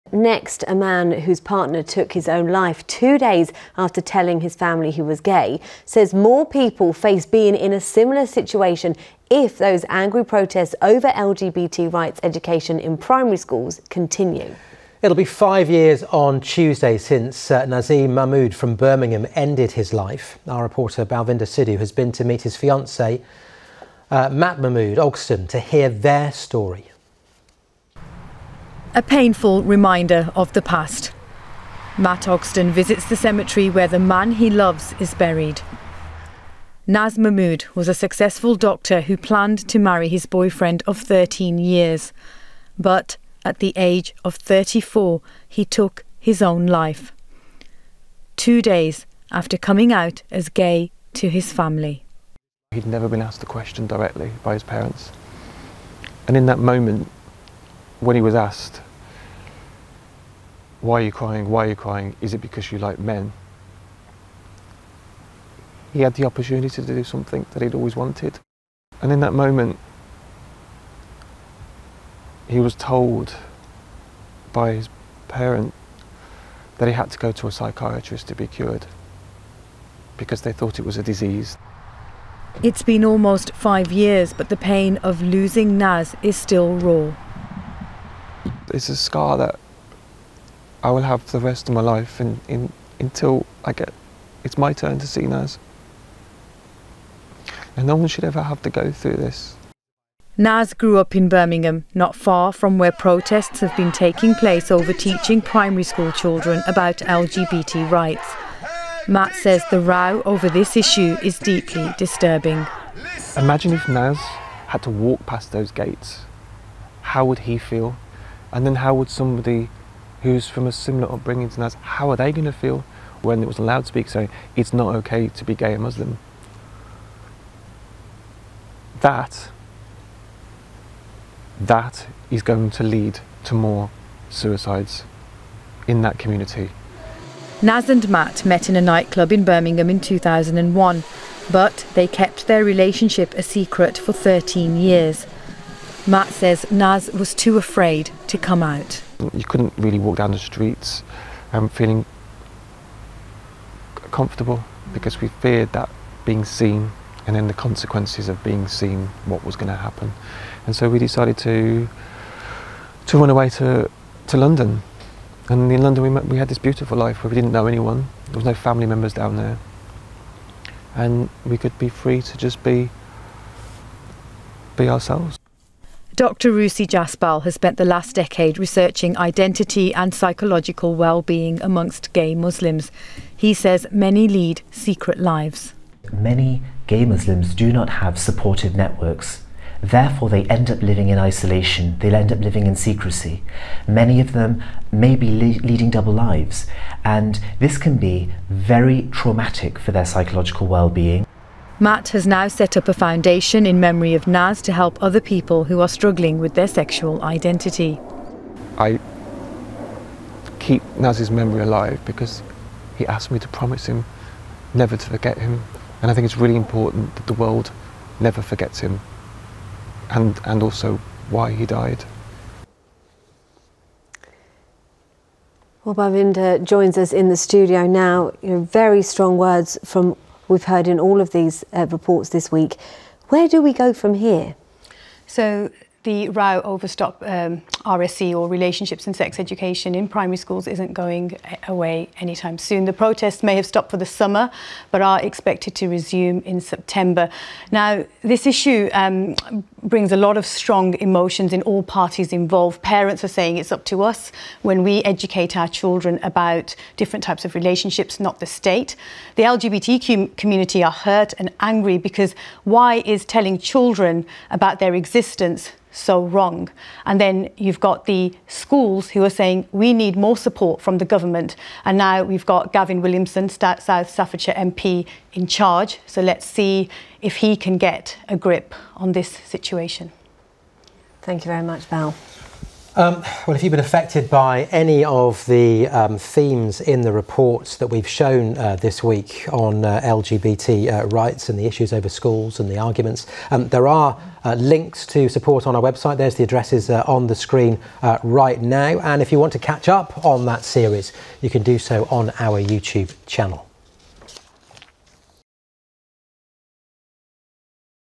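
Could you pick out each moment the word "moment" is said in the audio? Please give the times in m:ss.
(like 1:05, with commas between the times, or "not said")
0:56, 1:09.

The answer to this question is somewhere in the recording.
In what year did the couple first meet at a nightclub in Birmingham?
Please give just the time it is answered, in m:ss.
2:19.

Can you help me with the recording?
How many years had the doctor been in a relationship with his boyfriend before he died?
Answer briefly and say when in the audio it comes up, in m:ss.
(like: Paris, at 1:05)
13, at 0:40.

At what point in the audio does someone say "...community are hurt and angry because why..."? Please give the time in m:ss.
4:20.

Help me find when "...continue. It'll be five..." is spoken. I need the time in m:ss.
0:13.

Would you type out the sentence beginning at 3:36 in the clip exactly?
And I think it's really important that the world never forgets him and, and also why he died.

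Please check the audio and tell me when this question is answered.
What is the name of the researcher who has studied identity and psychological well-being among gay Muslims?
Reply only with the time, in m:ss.
2:56.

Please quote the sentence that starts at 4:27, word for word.
And then you've got the schools who are saying we need more support from the government.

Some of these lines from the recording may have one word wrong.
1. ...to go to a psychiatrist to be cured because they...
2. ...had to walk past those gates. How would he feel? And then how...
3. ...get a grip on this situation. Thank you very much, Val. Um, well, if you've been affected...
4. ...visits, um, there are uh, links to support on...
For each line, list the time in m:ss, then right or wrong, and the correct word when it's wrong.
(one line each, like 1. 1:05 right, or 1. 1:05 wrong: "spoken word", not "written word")
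1. 1:17 right
2. 1:54 right
3. 4:37 right
4. 4:52 wrong: "arguments", not "visits".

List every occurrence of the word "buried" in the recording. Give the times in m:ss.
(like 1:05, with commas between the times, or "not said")
0:35.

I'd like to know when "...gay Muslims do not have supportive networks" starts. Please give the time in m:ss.
3:06.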